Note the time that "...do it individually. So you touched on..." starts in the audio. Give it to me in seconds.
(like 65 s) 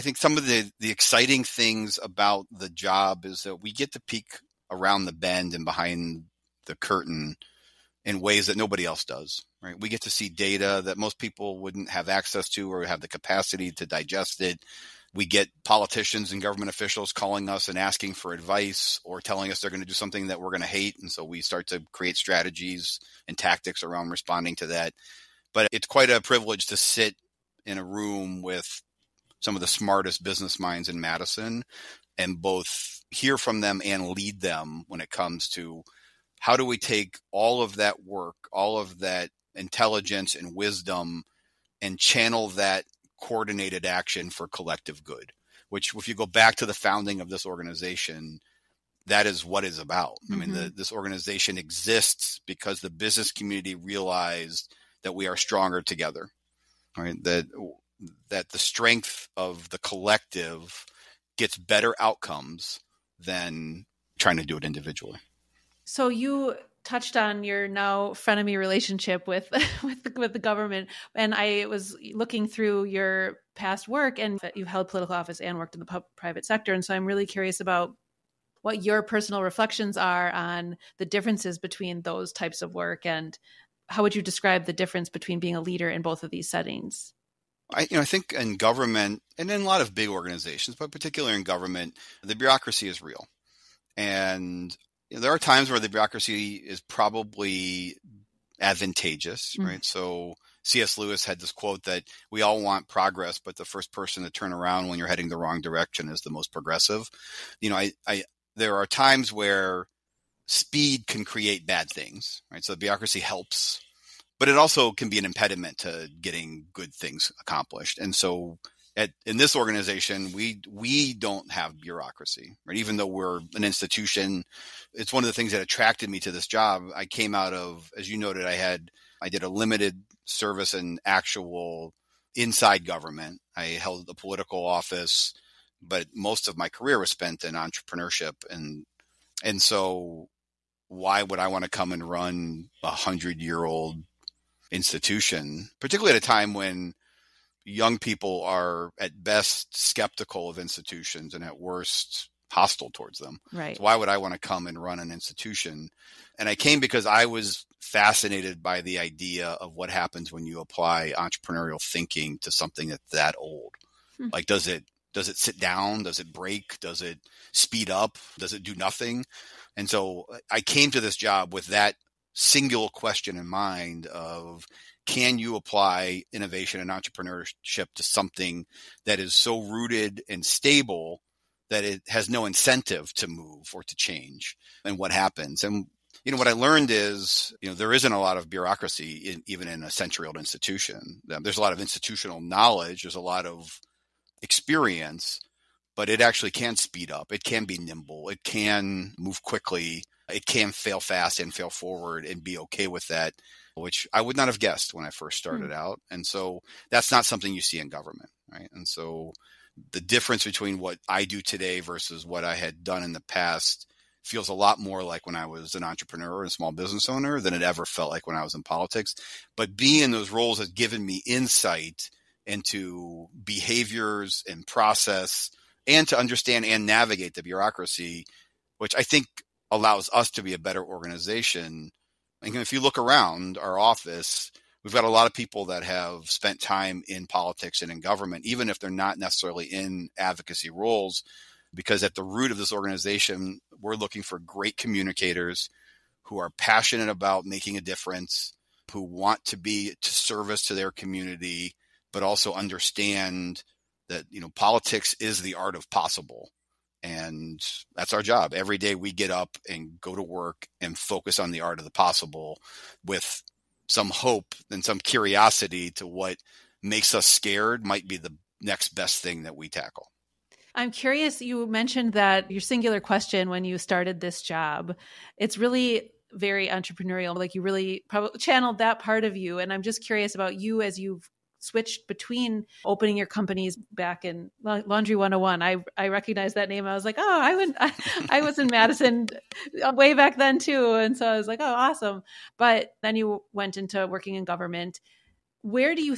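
64 s.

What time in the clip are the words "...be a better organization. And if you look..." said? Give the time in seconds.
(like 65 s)
230 s.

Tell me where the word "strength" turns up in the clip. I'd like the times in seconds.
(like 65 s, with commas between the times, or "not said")
58 s.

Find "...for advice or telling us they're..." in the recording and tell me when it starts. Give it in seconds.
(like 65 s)
18 s.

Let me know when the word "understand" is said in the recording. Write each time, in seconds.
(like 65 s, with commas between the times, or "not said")
226 s, 252 s.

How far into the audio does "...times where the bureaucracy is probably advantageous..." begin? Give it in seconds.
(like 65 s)
95 s.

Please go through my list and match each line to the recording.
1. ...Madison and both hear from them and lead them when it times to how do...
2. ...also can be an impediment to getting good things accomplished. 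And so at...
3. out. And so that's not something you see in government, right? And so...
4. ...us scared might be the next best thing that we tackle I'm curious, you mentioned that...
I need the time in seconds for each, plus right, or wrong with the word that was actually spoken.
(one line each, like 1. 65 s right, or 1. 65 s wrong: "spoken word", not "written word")
1. 31 s wrong: "comes", not "times"
2. 114 s right
3. 205 s right
4. 267 s right.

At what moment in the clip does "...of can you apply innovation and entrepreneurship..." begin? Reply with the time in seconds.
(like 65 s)
174 s.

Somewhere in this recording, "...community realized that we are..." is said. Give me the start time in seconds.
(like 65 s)
53 s.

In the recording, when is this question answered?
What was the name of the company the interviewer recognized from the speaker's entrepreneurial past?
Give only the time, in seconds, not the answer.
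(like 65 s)
284 s.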